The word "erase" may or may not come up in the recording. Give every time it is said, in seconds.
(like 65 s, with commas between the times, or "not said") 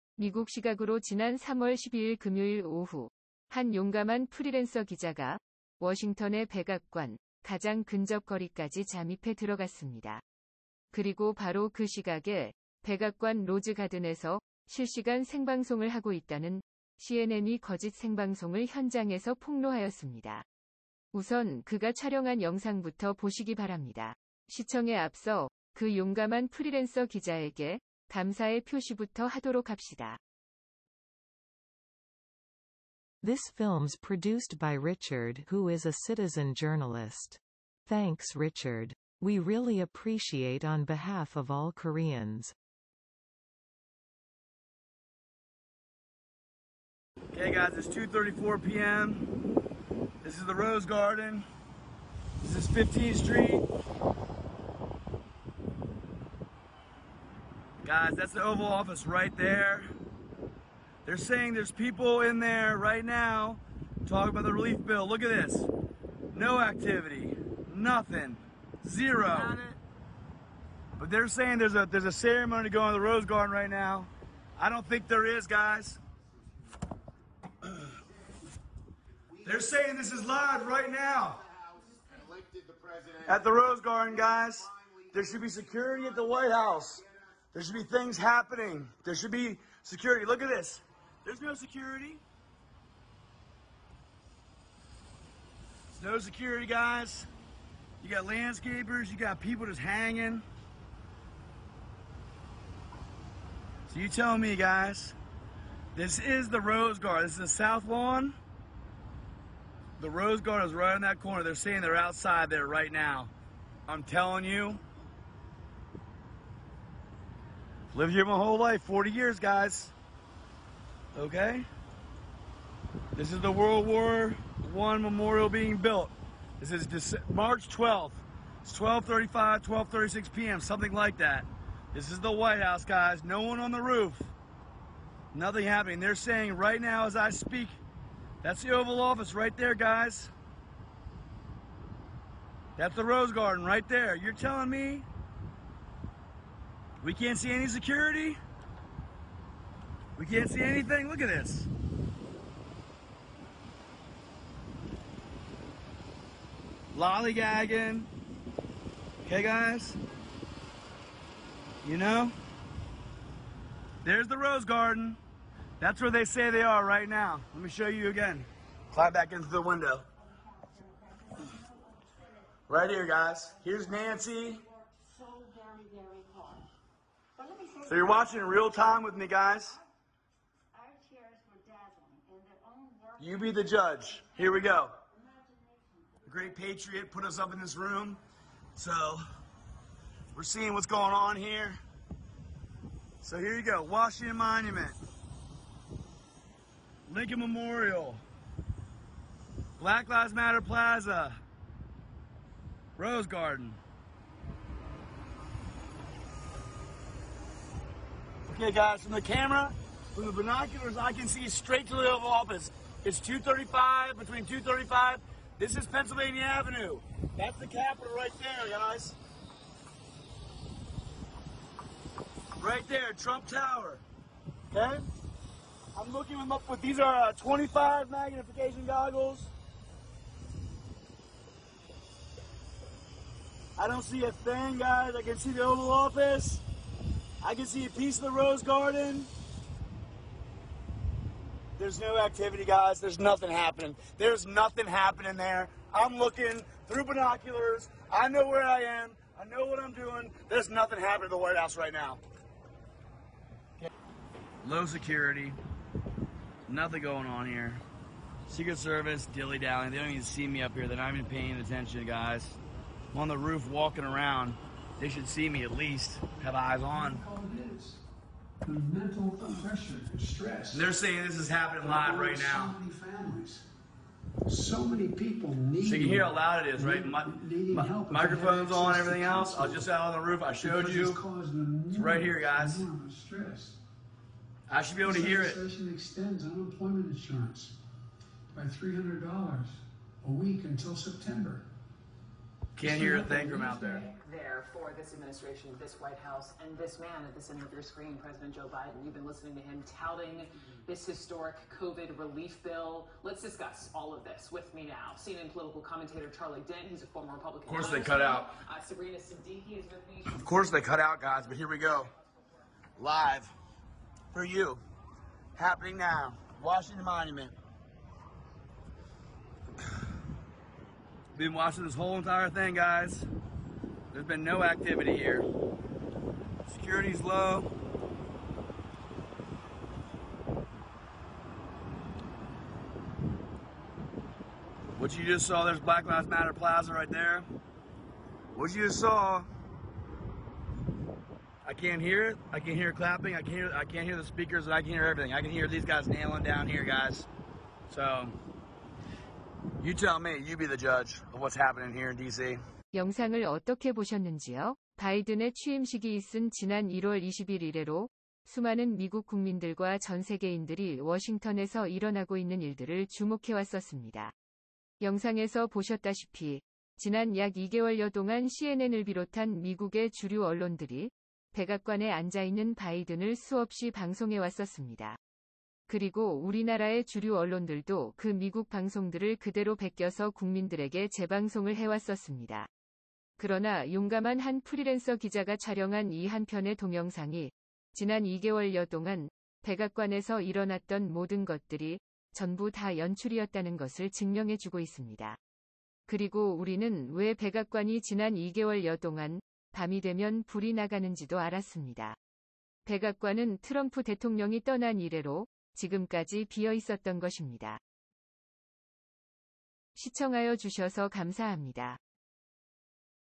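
not said.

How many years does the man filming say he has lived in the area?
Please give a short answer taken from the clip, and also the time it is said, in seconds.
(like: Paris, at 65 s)
40 years, at 118 s.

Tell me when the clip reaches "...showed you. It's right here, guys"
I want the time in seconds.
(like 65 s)
280 s.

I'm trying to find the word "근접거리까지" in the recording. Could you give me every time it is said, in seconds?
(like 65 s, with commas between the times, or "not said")
7 s.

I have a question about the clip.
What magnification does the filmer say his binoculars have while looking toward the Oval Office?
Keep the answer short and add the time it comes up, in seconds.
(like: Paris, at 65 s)
25, at 227 s.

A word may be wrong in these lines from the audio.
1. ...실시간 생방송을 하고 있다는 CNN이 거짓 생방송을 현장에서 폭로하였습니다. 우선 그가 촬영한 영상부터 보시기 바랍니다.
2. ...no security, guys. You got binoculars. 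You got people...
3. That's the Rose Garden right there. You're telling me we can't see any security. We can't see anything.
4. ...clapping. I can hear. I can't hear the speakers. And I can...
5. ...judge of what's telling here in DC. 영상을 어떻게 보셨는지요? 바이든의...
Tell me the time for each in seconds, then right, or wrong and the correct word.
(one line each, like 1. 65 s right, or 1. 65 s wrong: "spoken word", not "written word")
1. 14 s right
2. 96 s wrong: "landscapers", not "binoculars"
3. 142 s right
4. 342 s right
5. 350 s wrong: "happening", not "telling".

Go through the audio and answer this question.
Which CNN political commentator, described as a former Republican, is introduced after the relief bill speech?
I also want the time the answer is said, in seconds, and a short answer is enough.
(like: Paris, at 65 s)
Charlie Dent, at 306 s.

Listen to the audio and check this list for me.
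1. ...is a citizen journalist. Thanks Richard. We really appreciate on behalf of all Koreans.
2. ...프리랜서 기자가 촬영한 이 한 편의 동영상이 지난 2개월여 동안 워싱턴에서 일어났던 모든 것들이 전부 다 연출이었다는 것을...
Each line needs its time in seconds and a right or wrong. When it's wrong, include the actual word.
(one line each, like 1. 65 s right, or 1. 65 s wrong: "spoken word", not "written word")
1. 35 s right
2. 384 s wrong: "백악관에서", not "워싱턴에서".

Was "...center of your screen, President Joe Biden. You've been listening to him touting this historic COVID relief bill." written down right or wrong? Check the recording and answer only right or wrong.
right.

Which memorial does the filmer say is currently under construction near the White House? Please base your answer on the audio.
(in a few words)
World War One memorial.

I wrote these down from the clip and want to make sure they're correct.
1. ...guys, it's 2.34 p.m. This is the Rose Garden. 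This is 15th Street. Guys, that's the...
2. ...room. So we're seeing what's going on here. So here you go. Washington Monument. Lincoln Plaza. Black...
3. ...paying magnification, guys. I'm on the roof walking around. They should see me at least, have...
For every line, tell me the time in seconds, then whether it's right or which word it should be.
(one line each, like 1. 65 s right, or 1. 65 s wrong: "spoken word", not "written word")
1. 47 s right
2. 187 s wrong: "Memorial", not "Plaza"
3. 261 s wrong: "attention", not "magnification".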